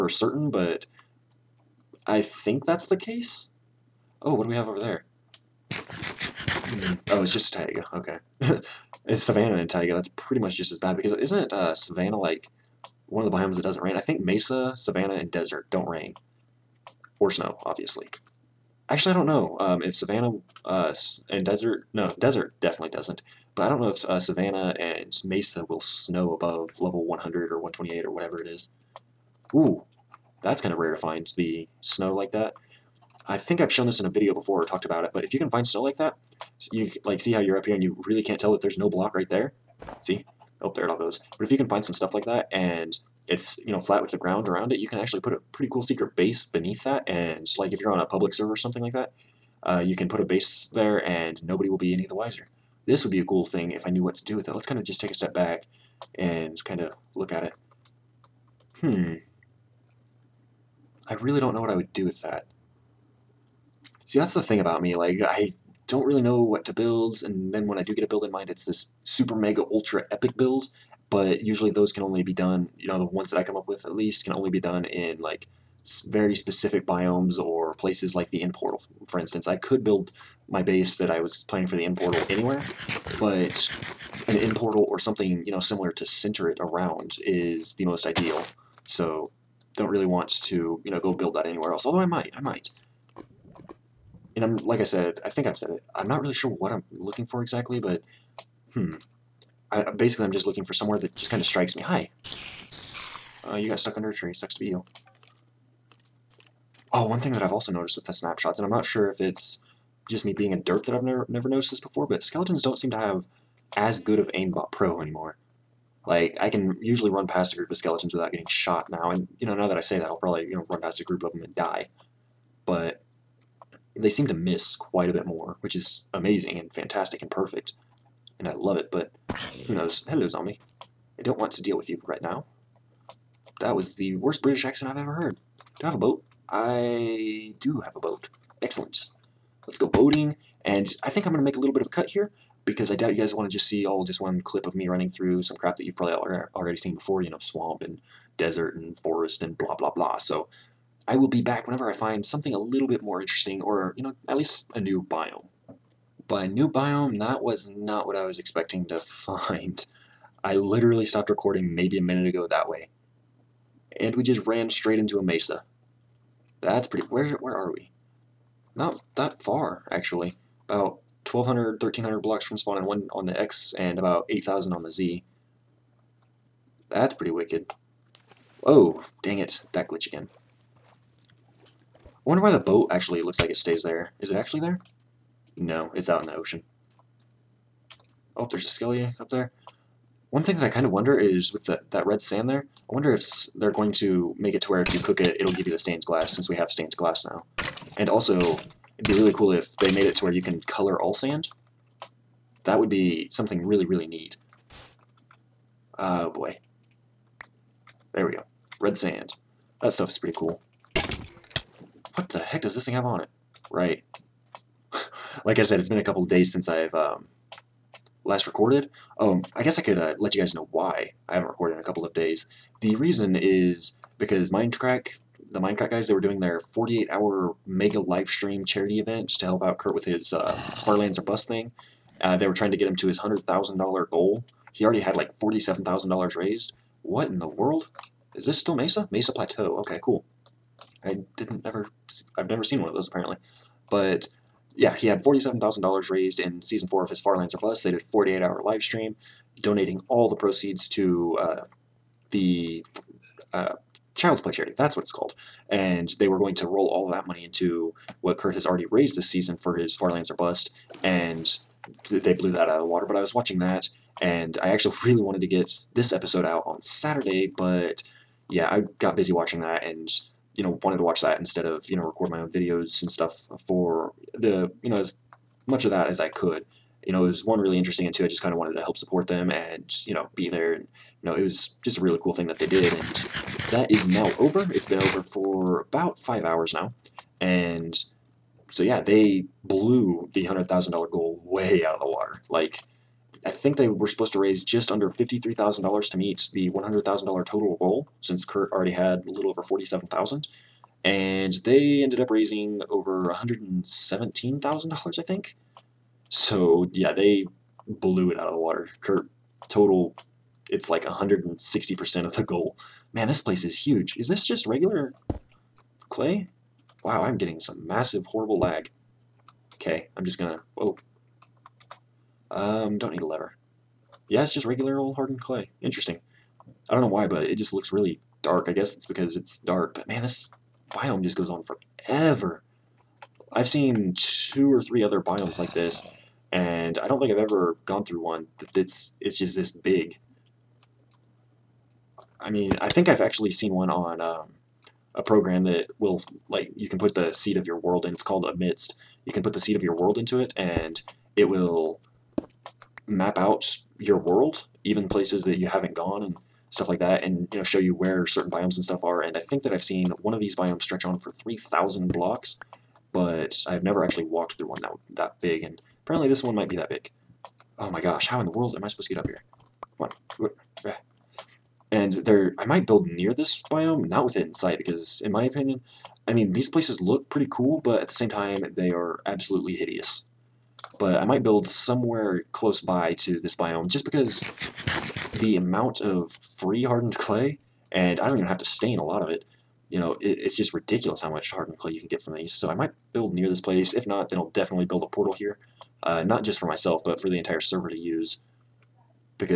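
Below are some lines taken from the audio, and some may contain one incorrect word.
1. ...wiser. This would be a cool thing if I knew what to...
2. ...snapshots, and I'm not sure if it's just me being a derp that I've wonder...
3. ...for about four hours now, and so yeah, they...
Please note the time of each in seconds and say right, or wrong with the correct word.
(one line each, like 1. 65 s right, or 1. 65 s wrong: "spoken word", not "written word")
1. 52 s right
2. 108 s wrong: "never", not "wonder"
3. 285 s wrong: "five", not "four".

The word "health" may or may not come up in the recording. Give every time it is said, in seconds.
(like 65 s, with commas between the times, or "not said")
not said.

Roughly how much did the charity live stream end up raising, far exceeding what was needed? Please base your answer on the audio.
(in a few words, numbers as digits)
over $117,000.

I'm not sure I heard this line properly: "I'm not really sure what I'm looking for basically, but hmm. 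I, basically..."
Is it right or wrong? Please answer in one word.
wrong.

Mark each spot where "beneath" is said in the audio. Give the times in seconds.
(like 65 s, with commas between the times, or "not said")
46 s.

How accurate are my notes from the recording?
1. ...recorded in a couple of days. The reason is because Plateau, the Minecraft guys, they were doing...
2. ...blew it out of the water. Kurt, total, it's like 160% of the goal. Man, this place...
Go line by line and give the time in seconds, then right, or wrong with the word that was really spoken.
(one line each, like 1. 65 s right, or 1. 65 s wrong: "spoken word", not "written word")
1. 221 s wrong: "Minecraft", not "Plateau"
2. 307 s right.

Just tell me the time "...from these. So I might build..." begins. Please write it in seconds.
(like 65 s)
392 s.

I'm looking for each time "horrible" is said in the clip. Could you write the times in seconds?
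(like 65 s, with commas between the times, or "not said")
318 s.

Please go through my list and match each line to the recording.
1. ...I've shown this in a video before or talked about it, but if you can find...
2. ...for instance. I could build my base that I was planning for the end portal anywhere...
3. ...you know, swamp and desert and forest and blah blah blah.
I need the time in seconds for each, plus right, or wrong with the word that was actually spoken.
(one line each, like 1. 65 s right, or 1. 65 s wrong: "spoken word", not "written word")
1. 33 s right
2. 79 s right
3. 147 s right.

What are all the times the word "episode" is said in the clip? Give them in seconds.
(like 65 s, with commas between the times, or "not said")
266 s.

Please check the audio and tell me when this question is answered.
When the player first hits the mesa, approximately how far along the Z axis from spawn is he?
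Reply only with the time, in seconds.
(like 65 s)
173 s.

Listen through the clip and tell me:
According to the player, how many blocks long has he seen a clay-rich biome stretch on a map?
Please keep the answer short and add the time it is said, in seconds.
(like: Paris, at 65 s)
3,000 blocks, at 361 s.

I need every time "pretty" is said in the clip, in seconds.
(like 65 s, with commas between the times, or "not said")
10 s, 45 s, 166 s, 177 s, 210 s, 377 s.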